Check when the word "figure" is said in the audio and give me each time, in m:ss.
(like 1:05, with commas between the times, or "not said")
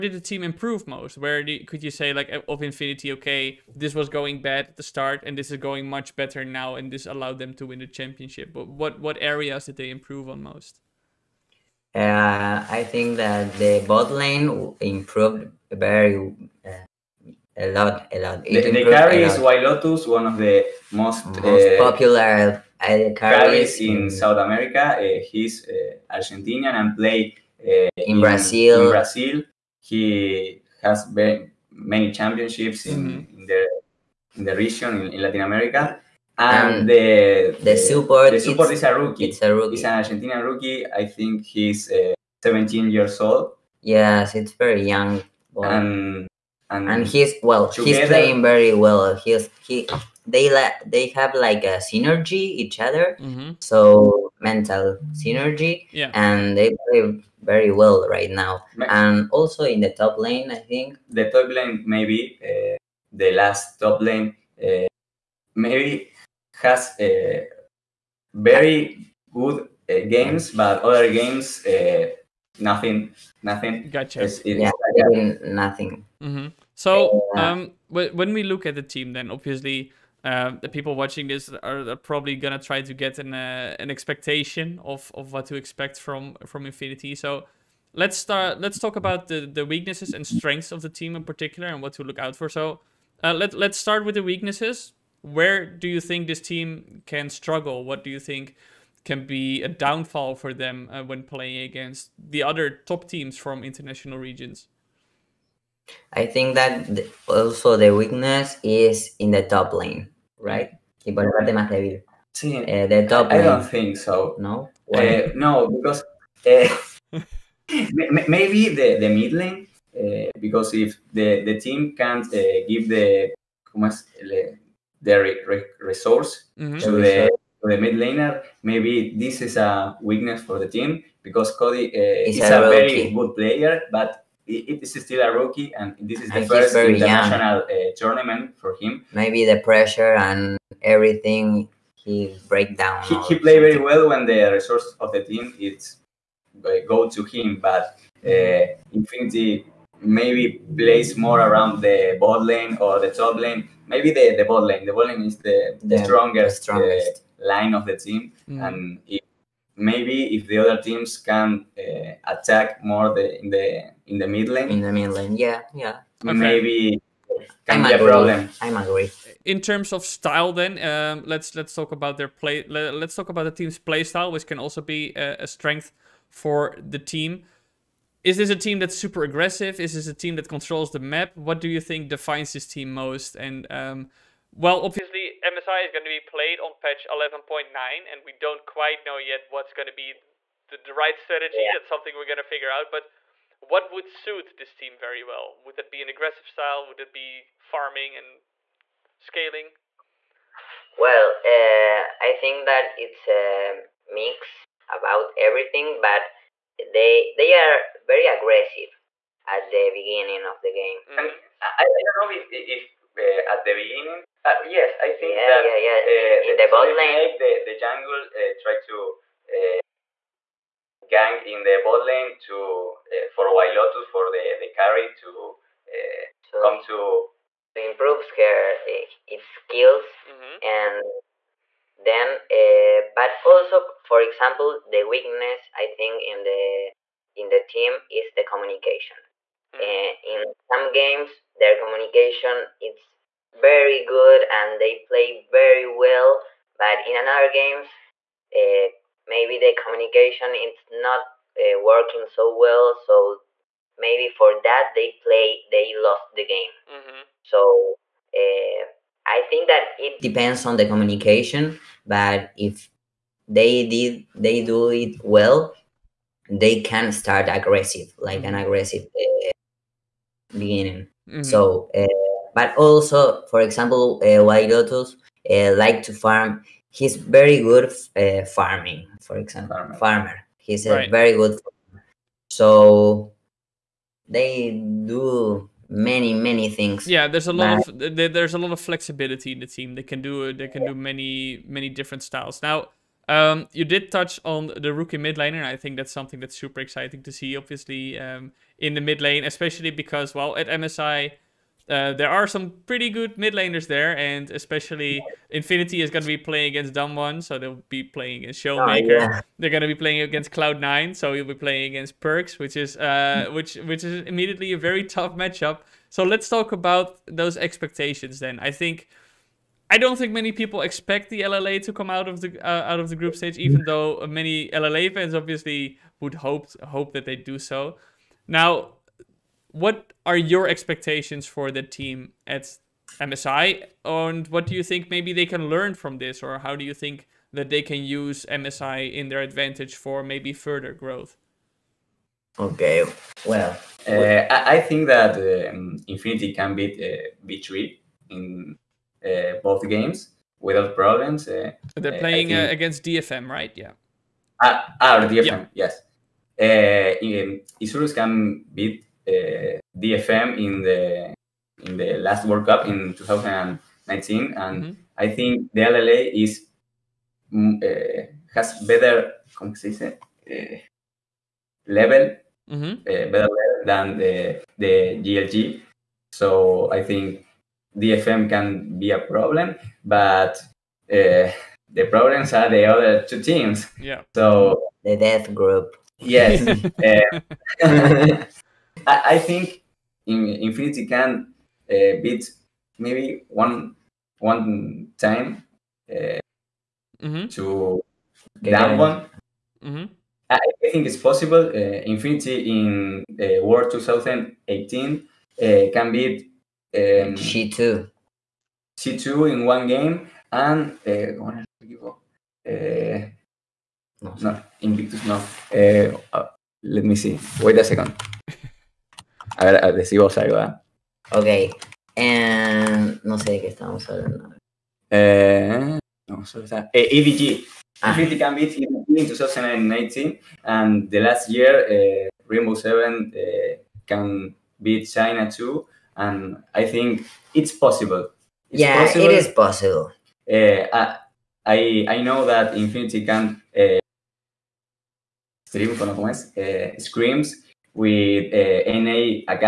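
3:12.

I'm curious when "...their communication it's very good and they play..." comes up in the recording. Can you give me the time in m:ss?
4:01.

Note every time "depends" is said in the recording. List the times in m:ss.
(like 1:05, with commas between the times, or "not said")
4:20.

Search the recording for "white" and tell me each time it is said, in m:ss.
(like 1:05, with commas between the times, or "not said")
0:19, 3:43, 4:34.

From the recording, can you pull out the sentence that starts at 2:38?
and if, maybe if the other teams can uh, attack more the in the in the mid lane.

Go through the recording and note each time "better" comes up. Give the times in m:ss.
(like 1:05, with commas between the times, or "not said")
0:06, 6:08, 6:13.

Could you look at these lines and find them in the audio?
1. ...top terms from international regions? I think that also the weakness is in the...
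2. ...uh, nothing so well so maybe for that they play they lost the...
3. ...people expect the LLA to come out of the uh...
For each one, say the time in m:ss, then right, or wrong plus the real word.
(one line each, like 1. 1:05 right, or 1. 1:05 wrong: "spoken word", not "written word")
1. 1:42 wrong: "teams", not "terms"
2. 4:11 wrong: "working", not "nothing"
3. 5:20 right.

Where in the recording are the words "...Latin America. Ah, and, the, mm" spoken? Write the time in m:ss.
0:35.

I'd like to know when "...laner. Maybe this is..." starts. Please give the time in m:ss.
2:07.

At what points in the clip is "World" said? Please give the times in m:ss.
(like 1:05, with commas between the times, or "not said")
6:02.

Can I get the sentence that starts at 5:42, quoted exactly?
Okay, well, uh, I think that um, Infinity can beat uh, B3 in uh, both games without problems.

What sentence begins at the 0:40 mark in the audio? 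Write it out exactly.
I think he's uh, 17 years old.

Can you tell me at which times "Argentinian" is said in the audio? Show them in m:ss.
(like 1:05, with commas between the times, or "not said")
0:26, 0:40.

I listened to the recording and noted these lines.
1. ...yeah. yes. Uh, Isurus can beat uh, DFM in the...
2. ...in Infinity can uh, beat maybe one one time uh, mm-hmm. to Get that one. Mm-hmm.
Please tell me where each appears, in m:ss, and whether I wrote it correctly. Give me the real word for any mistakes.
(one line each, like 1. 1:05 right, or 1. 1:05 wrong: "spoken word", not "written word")
1. 5:55 right
2. 6:30 right.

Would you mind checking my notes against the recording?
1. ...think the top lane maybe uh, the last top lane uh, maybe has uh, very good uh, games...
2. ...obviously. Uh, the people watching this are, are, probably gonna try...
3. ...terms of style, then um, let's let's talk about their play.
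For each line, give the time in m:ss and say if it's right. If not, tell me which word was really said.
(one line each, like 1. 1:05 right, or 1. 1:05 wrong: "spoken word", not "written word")
1. 1:00 right
2. 1:19 right
3. 2:49 right.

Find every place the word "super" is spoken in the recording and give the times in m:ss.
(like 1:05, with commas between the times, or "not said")
2:58, 4:56.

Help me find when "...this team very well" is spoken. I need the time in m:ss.
3:14.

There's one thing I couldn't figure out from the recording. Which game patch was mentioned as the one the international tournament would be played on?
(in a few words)
11.9.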